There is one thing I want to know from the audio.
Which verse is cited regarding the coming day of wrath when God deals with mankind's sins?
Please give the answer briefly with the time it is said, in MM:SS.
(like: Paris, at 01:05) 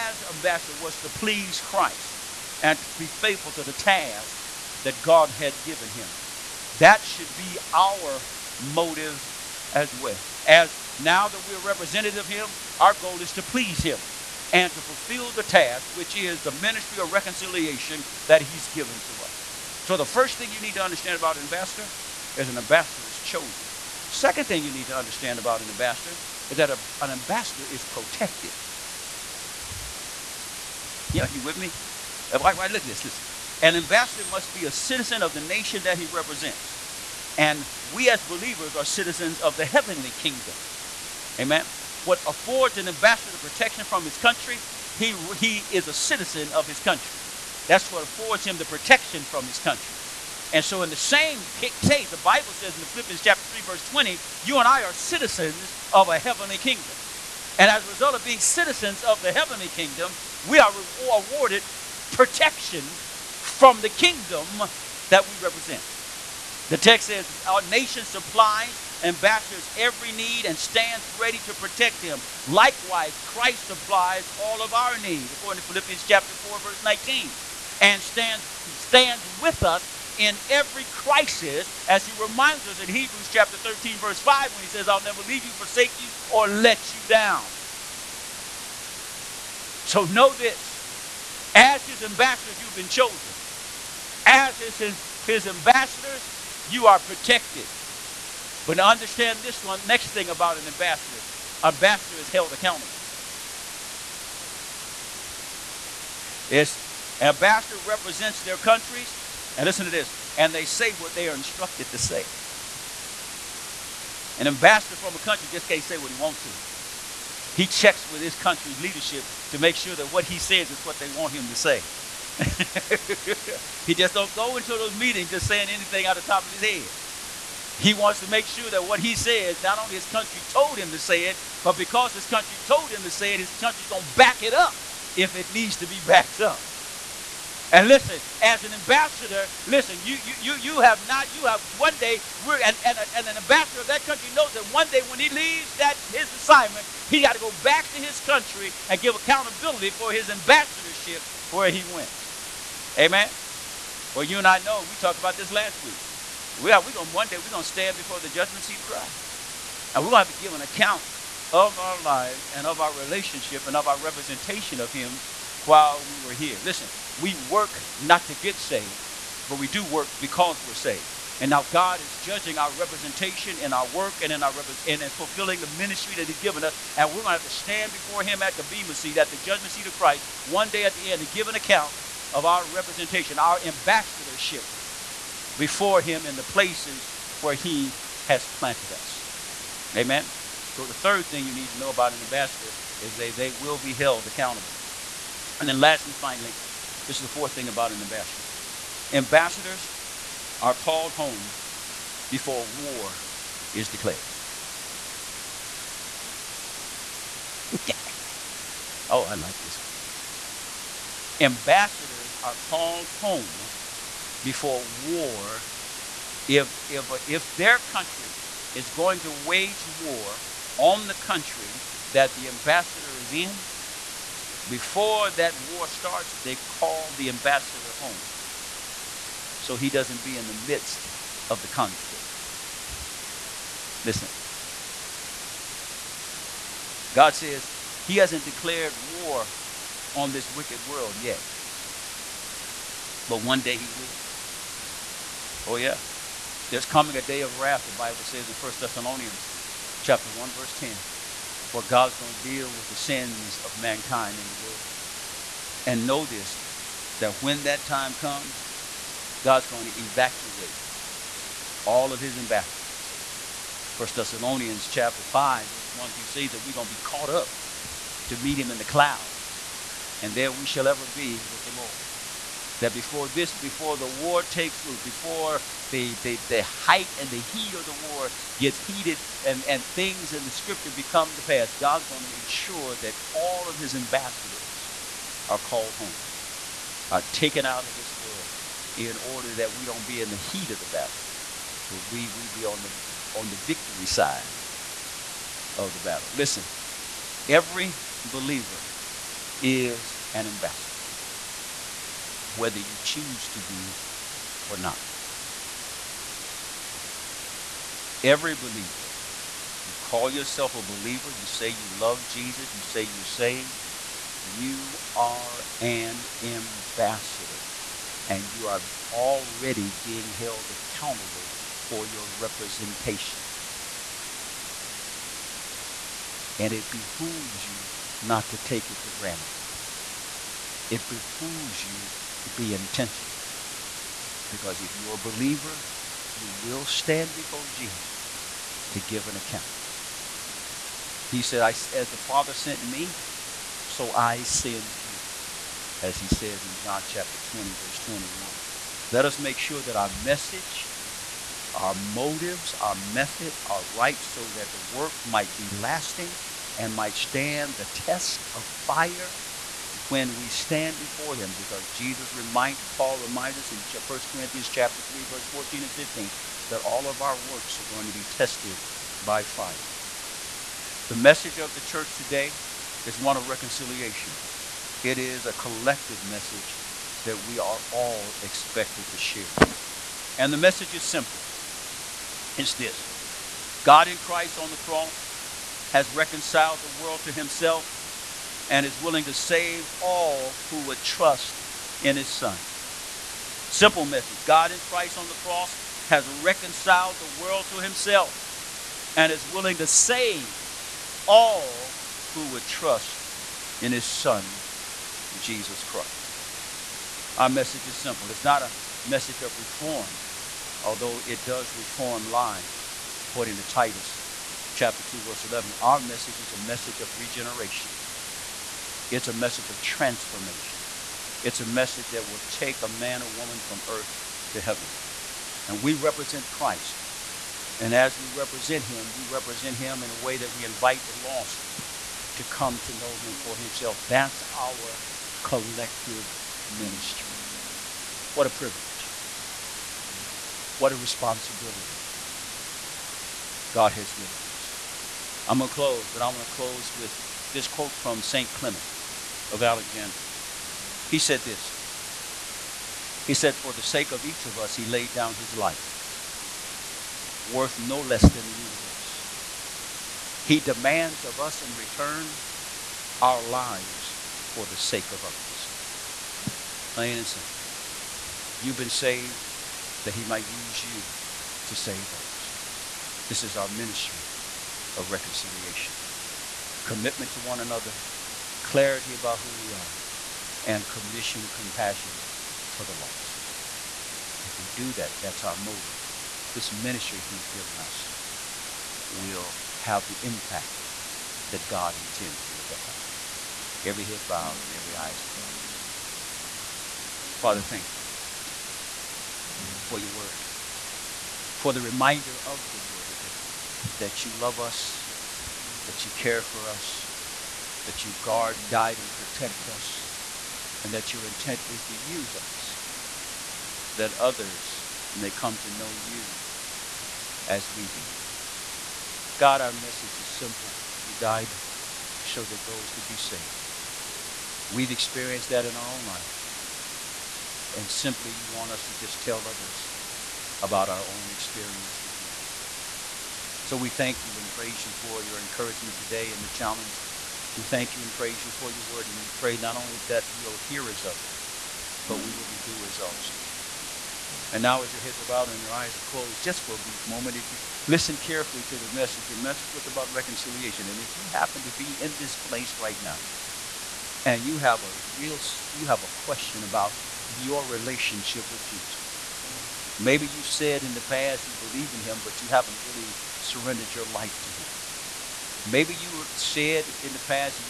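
1 Thessalonians 1:10, at 04:08.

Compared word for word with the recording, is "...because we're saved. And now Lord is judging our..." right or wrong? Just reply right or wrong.
wrong.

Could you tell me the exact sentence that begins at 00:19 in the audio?
So, the first thing you need to understand about an ambassador is an ambassador is chosen.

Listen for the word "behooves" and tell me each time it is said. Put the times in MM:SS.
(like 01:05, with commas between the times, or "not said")
05:26, 05:31.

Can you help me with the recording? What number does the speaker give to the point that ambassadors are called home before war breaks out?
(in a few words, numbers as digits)
4.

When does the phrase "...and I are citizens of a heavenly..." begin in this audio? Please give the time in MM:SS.
00:54.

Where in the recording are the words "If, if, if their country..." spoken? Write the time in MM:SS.
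03:36.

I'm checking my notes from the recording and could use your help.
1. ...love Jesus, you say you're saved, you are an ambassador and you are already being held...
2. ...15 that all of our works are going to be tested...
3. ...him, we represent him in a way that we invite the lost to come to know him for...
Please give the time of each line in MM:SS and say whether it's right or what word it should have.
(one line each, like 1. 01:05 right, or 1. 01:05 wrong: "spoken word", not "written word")
1. 05:11 right
2. 06:05 right
3. 07:08 right.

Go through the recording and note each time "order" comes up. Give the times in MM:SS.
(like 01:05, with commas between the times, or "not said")
04:49.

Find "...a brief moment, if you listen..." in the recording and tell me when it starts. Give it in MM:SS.
09:06.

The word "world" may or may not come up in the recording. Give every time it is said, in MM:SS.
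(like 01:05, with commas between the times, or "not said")
04:00, 04:14, 04:48, 06:26, 06:37.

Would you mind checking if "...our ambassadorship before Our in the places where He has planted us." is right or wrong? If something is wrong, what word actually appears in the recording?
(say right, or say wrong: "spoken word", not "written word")
wrong: "Him", not "Our".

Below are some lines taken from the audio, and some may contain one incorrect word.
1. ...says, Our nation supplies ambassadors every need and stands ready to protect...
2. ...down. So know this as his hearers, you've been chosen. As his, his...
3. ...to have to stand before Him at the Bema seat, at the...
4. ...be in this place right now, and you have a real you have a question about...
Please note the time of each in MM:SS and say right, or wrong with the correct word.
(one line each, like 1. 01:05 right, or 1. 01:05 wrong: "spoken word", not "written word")
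1. 01:07 right
2. 01:27 wrong: "ambassadors", not "hearers"
3. 02:57 right
4. 09:11 right.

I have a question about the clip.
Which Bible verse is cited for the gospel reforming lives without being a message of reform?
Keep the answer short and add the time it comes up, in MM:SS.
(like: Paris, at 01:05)
Titus 2:11, at 06:53.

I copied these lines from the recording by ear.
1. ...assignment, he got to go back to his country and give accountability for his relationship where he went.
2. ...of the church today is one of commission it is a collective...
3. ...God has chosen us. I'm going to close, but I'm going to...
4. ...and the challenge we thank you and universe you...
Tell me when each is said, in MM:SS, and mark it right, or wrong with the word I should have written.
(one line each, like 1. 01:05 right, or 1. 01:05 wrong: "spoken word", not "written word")
1. 02:26 wrong: "ambassadorship", not "relationship"
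2. 06:11 wrong: "reconciliation", not "commission"
3. 07:23 wrong: "given", not "chosen"
4. 08:56 wrong: "praise", not "universe".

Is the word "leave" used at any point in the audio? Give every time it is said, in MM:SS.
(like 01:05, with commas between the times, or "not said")
01:25, 02:25.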